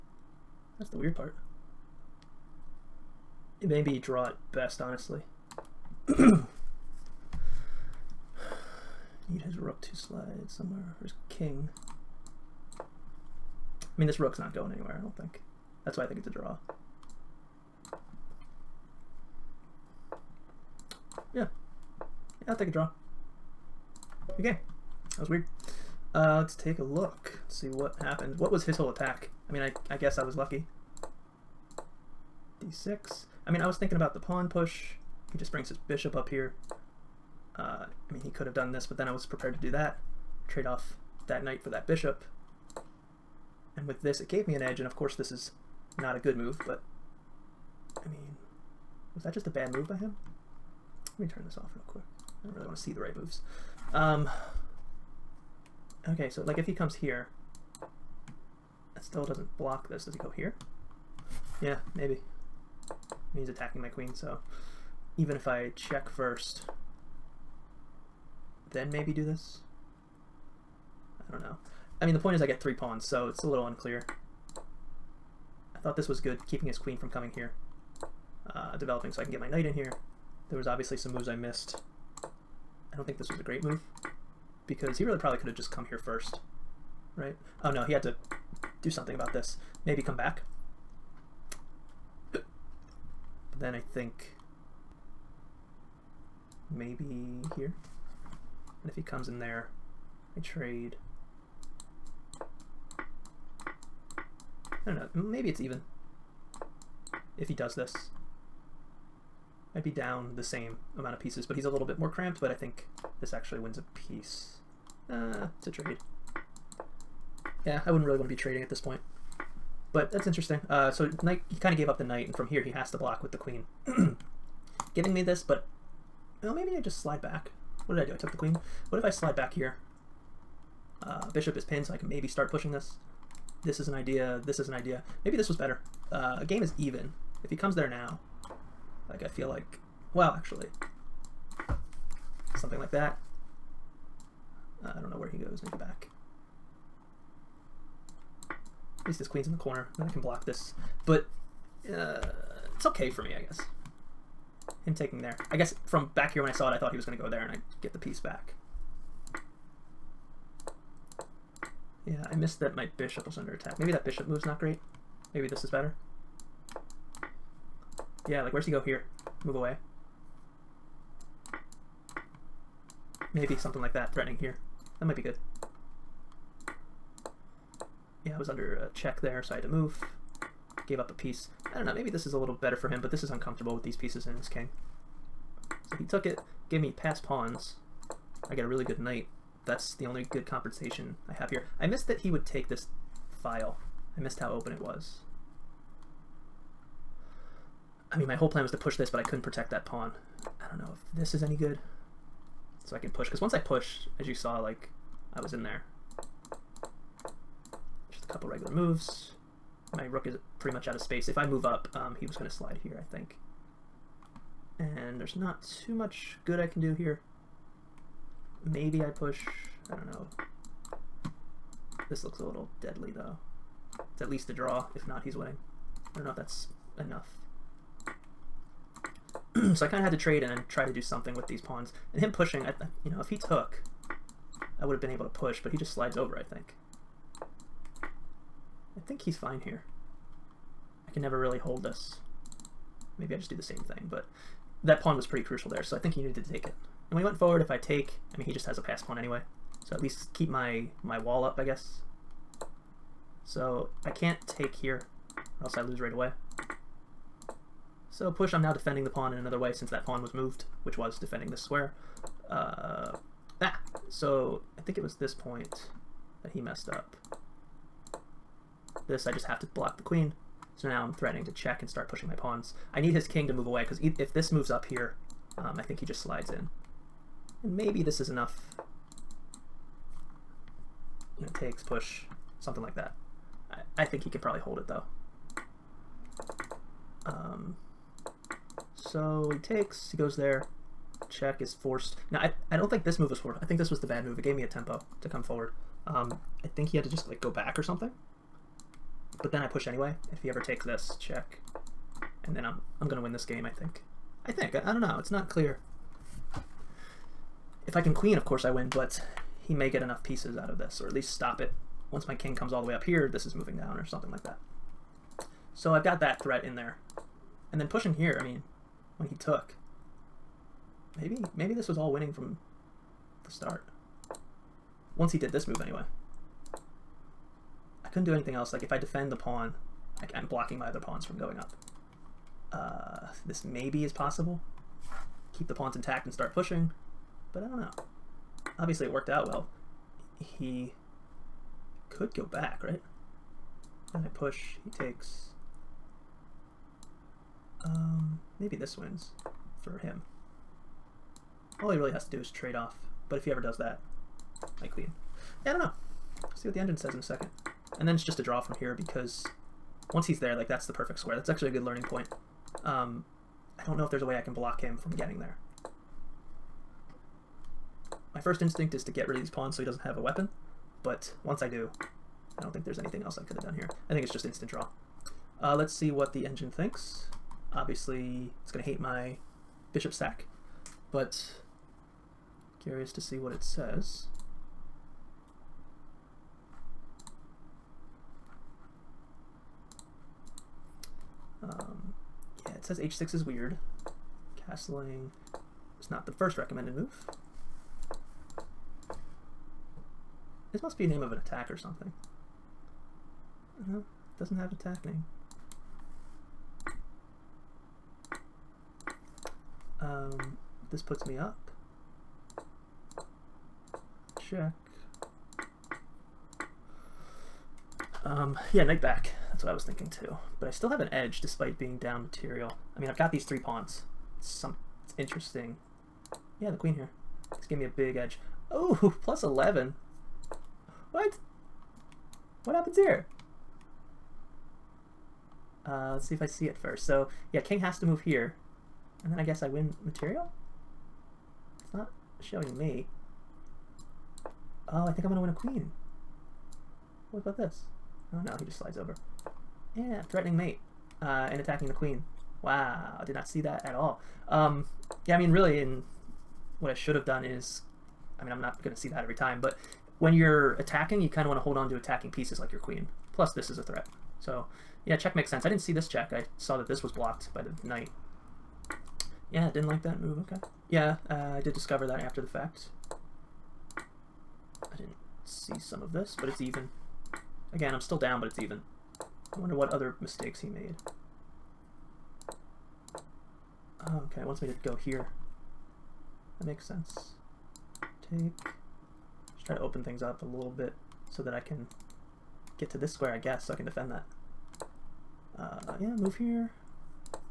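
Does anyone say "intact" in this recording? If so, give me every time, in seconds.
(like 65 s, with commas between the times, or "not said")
335 s.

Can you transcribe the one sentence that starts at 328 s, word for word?
Like if I defend the pawn, I, am blocking my other pawns from going up.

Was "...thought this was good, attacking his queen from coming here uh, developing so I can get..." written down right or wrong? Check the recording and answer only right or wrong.
wrong.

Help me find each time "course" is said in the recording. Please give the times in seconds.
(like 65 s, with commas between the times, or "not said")
44 s, 308 s.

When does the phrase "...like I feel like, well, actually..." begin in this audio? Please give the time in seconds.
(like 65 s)
139 s.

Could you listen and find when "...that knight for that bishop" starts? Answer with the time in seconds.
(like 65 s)
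41 s.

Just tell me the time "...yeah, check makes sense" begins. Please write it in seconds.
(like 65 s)
465 s.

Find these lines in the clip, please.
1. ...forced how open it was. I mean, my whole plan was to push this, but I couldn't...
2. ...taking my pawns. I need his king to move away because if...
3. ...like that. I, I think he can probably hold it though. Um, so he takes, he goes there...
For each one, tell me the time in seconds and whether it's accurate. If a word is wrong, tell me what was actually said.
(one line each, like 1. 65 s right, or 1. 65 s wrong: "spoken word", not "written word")
1. 194 s wrong: "missed", not "forced"
2. 272 s wrong: "pushing", not "taking"
3. 282 s right.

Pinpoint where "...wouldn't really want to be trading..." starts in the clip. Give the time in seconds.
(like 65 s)
117 s.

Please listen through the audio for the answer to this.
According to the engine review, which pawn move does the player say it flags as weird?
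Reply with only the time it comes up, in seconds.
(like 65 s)
392 s.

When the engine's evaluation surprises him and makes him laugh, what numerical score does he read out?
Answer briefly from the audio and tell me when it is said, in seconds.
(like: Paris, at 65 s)
Plus 11, at 429 s.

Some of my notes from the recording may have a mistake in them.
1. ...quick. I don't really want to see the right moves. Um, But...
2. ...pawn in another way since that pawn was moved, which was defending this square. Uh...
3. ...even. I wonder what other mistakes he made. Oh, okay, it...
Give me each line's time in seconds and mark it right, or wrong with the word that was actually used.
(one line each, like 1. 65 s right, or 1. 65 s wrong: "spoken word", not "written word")
1. 51 s wrong: "Okay", not "But"
2. 259 s right
3. 478 s right.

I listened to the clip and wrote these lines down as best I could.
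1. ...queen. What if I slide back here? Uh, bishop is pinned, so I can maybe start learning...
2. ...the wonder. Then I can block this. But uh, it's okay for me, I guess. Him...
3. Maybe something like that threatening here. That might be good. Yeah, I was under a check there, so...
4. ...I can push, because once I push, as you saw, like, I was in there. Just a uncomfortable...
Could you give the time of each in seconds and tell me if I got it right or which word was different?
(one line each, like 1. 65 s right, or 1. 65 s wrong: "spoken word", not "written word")
1. 128 s wrong: "pushing", not "learning"
2. 149 s wrong: "corner", not "wonder"
3. 173 s right
4. 202 s wrong: "couple", not "uncomfortable".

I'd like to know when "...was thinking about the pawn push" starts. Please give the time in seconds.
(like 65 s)
33 s.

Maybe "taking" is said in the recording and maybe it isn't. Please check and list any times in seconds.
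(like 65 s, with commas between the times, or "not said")
154 s.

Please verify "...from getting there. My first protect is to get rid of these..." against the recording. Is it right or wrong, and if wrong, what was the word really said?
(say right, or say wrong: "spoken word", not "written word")
wrong: "instinct", not "protect".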